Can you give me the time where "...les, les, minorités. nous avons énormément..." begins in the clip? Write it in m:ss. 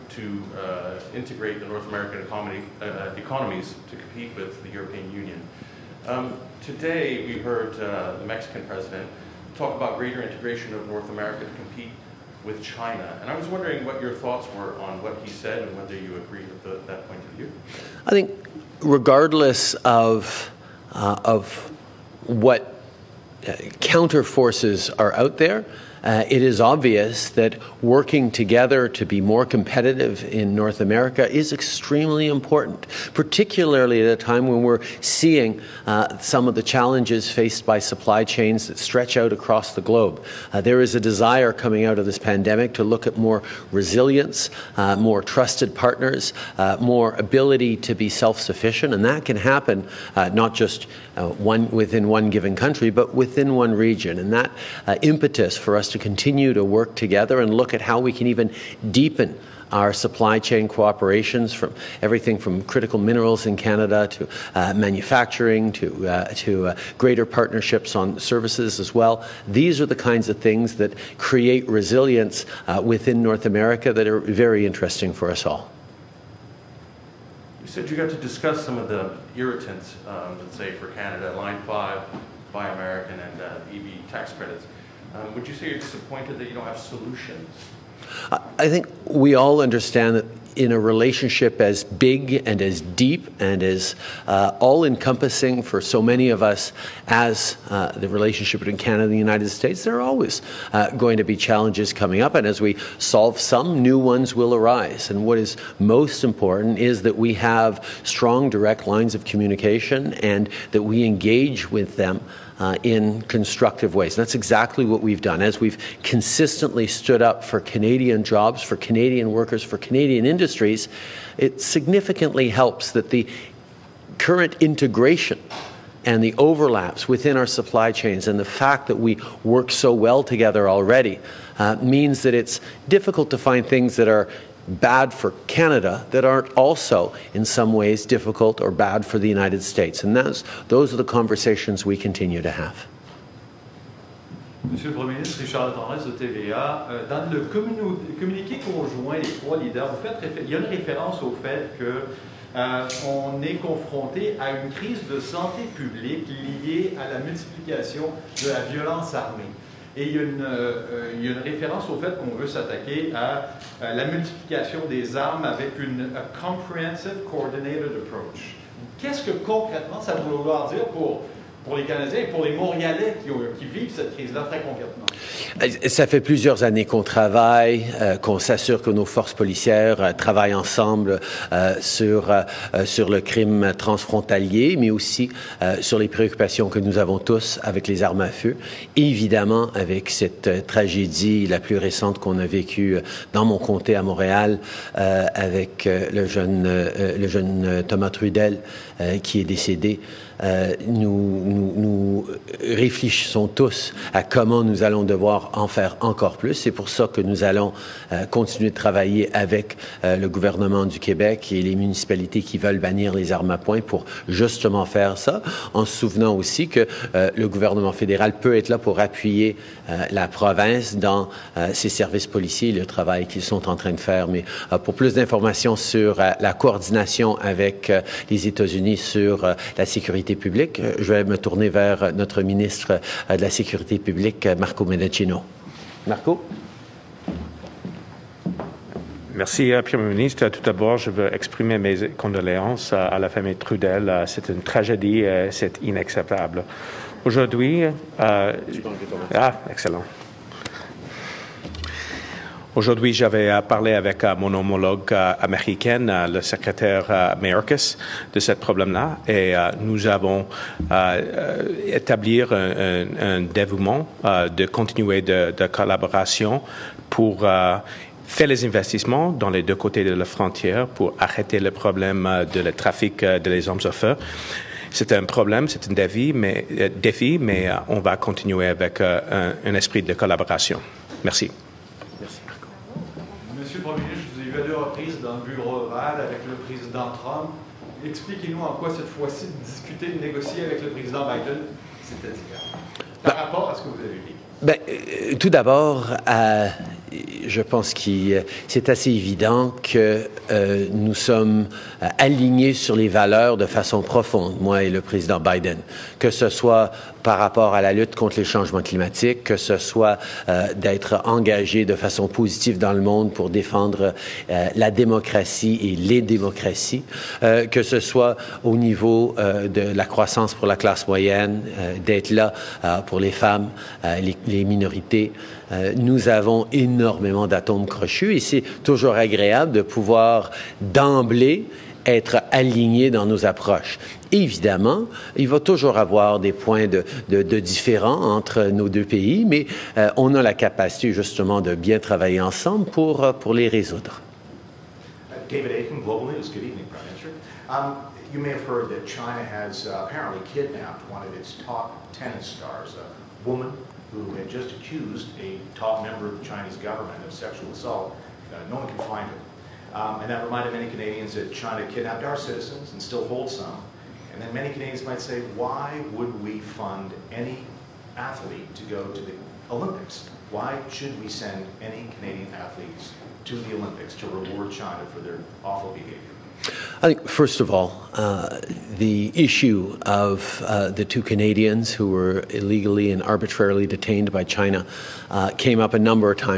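5:24.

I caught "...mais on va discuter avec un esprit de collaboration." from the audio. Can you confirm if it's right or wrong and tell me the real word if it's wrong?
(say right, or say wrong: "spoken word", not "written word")
wrong: "continuer", not "discuter".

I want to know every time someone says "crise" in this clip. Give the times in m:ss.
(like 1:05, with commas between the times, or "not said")
2:34, 2:54.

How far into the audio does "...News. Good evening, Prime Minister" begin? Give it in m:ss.
5:46.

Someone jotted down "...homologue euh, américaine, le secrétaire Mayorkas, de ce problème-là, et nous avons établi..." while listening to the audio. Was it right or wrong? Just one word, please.
right.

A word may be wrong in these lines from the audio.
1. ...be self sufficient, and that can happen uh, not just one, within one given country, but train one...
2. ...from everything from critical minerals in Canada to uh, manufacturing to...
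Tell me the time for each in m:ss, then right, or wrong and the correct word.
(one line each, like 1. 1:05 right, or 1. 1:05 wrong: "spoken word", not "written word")
1. 0:47 wrong: "within", not "train"
2. 1:01 right.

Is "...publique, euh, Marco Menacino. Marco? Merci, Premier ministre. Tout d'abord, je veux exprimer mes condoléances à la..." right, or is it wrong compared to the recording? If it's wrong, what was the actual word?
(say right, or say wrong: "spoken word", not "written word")
right.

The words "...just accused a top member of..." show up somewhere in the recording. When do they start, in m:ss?
5:54.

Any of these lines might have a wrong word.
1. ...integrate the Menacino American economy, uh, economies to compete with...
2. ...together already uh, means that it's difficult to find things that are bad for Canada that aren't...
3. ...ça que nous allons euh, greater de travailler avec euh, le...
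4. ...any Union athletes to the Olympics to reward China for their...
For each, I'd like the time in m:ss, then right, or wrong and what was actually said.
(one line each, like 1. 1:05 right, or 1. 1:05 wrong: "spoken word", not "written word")
1. 0:01 wrong: "North", not "Menacino"
2. 2:10 right
3. 3:26 wrong: "continuer", not "greater"
4. 6:11 wrong: "Canadian", not "Union".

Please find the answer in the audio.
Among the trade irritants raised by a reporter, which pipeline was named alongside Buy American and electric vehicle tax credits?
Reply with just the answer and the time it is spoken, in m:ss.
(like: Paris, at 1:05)
Line 5, at 1:21.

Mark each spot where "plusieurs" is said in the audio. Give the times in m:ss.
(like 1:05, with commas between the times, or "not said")
2:56.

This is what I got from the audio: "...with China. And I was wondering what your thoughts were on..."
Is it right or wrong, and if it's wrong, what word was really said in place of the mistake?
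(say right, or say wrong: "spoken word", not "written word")
right.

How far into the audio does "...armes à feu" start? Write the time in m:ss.
3:08.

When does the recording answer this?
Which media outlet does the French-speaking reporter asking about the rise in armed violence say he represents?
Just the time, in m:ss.
2:26.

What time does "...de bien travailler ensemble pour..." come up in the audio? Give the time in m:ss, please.
5:41.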